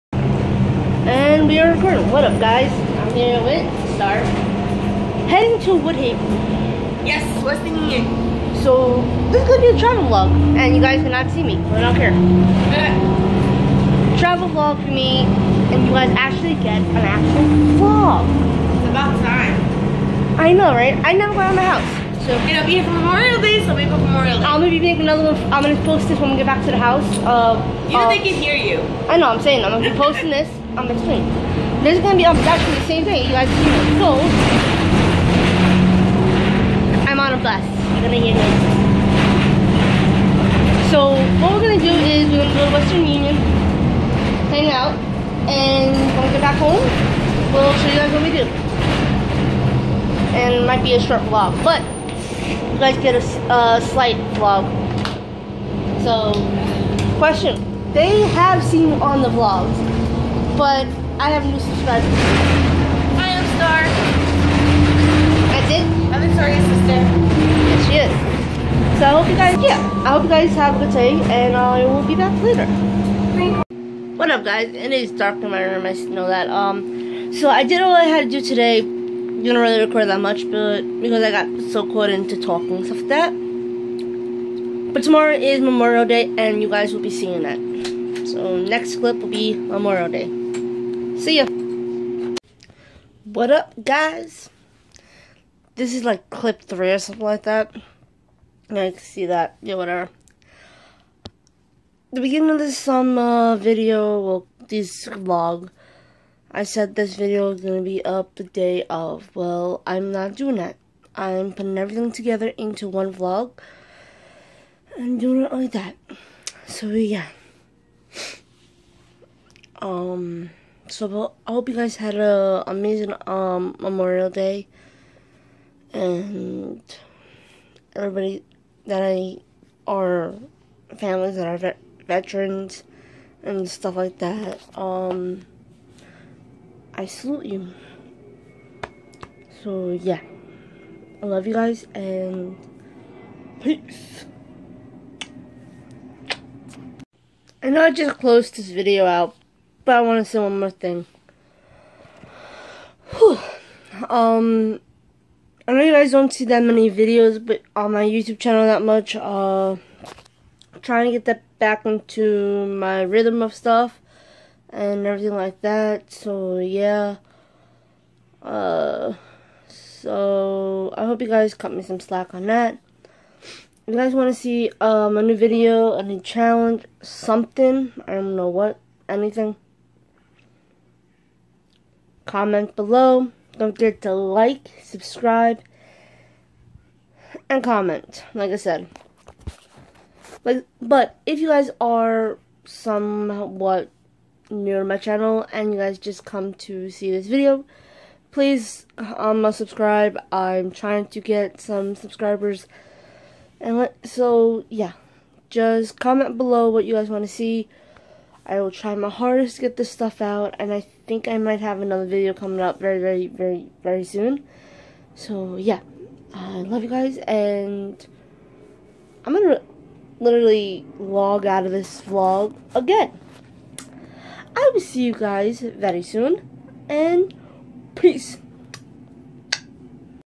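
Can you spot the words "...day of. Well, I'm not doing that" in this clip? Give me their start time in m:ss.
1:48.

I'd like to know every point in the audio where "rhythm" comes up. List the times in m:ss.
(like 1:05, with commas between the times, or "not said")
2:43.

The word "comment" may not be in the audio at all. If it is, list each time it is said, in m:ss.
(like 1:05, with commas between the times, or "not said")
3:02, 3:07, 3:25.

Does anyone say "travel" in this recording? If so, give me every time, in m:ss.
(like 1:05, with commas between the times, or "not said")
0:09, 0:14.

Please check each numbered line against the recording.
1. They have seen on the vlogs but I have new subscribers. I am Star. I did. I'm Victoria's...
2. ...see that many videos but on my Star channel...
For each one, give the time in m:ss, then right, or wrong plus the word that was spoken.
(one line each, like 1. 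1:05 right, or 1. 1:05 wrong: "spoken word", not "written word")
1. 0:57 right
2. 2:36 wrong: "YouTube", not "Star".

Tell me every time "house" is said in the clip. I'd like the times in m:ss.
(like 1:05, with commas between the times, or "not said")
0:21, 0:26.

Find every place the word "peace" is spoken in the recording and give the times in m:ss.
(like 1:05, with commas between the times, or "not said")
2:23, 3:47.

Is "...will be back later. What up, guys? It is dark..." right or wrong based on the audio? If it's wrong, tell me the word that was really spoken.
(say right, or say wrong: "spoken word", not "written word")
right.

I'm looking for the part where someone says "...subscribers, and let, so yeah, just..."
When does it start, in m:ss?
3:21.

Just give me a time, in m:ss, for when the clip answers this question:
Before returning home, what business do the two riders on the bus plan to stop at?
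0:42.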